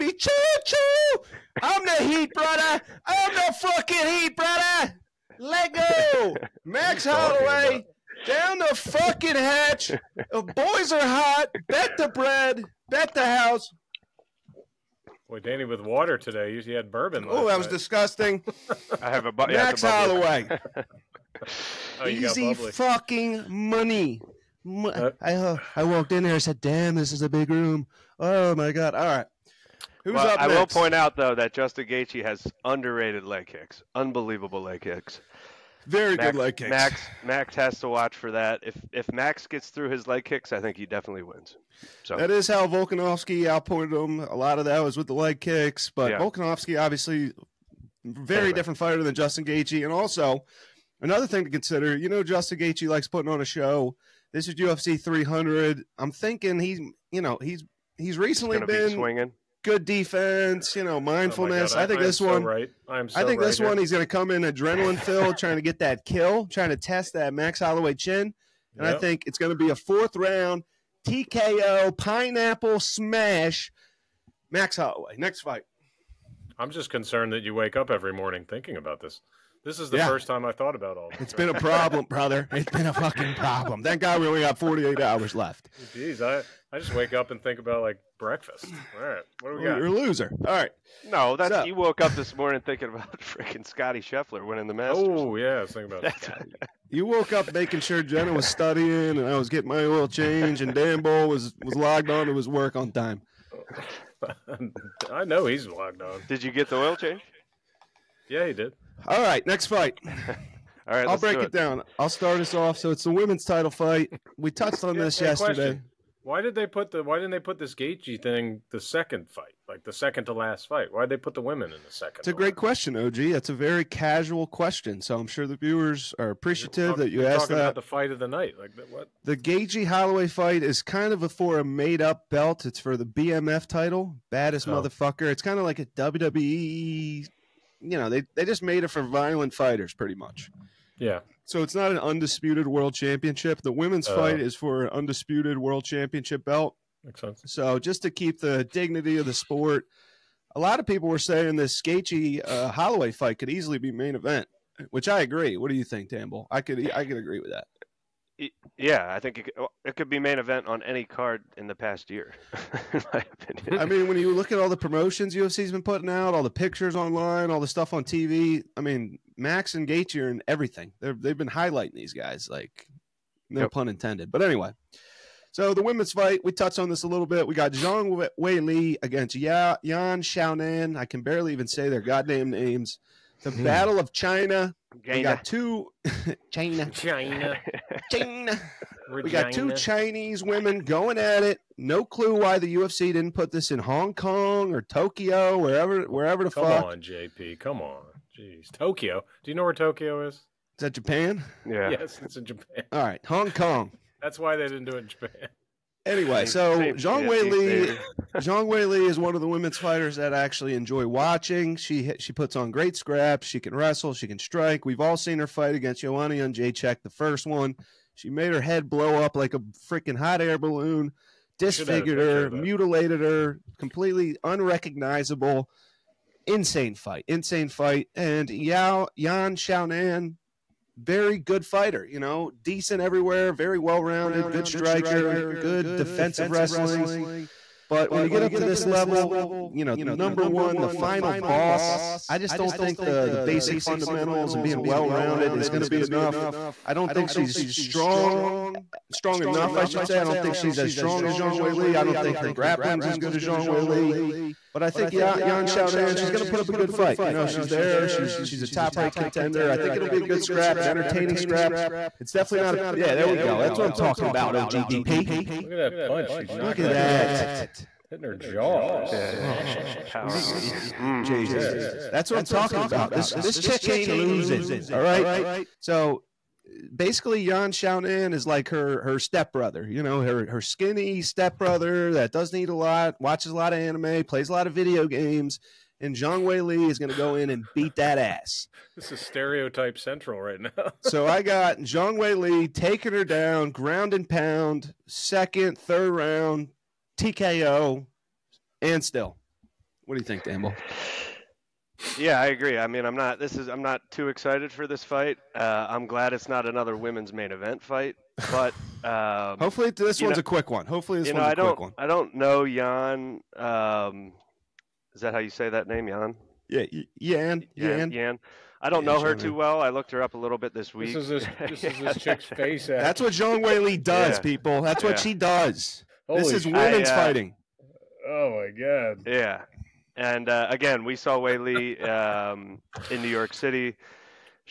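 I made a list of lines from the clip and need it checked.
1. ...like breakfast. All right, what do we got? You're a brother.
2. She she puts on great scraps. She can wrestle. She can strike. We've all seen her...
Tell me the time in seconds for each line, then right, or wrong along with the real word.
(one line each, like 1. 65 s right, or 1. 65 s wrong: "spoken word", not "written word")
1. 87 s wrong: "loser", not "brother"
2. 211 s right.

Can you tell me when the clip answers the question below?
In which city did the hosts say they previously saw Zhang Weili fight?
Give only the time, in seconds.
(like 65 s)
333 s.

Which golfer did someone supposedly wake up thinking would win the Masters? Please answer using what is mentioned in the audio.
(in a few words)
Scotty Scheffler.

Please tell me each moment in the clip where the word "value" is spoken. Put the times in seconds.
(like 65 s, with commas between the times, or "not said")
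not said.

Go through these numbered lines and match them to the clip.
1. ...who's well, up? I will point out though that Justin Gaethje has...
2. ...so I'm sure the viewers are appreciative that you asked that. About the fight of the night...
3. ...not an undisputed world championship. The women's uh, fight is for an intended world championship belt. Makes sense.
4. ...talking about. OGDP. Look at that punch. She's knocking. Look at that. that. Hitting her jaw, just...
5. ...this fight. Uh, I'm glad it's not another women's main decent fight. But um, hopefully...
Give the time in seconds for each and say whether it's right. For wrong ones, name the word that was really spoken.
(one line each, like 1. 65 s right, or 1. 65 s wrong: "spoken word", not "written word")
1. 30 s right
2. 124 s right
3. 141 s wrong: "undisputed", not "intended"
4. 263 s right
5. 304 s wrong: "event", not "decent".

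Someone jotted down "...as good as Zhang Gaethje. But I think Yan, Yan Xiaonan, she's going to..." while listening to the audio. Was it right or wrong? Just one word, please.
wrong.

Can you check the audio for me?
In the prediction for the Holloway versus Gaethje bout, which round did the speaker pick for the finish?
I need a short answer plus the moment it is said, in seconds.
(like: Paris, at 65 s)
4th round, at 69 s.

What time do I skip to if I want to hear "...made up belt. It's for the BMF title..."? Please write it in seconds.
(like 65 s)
131 s.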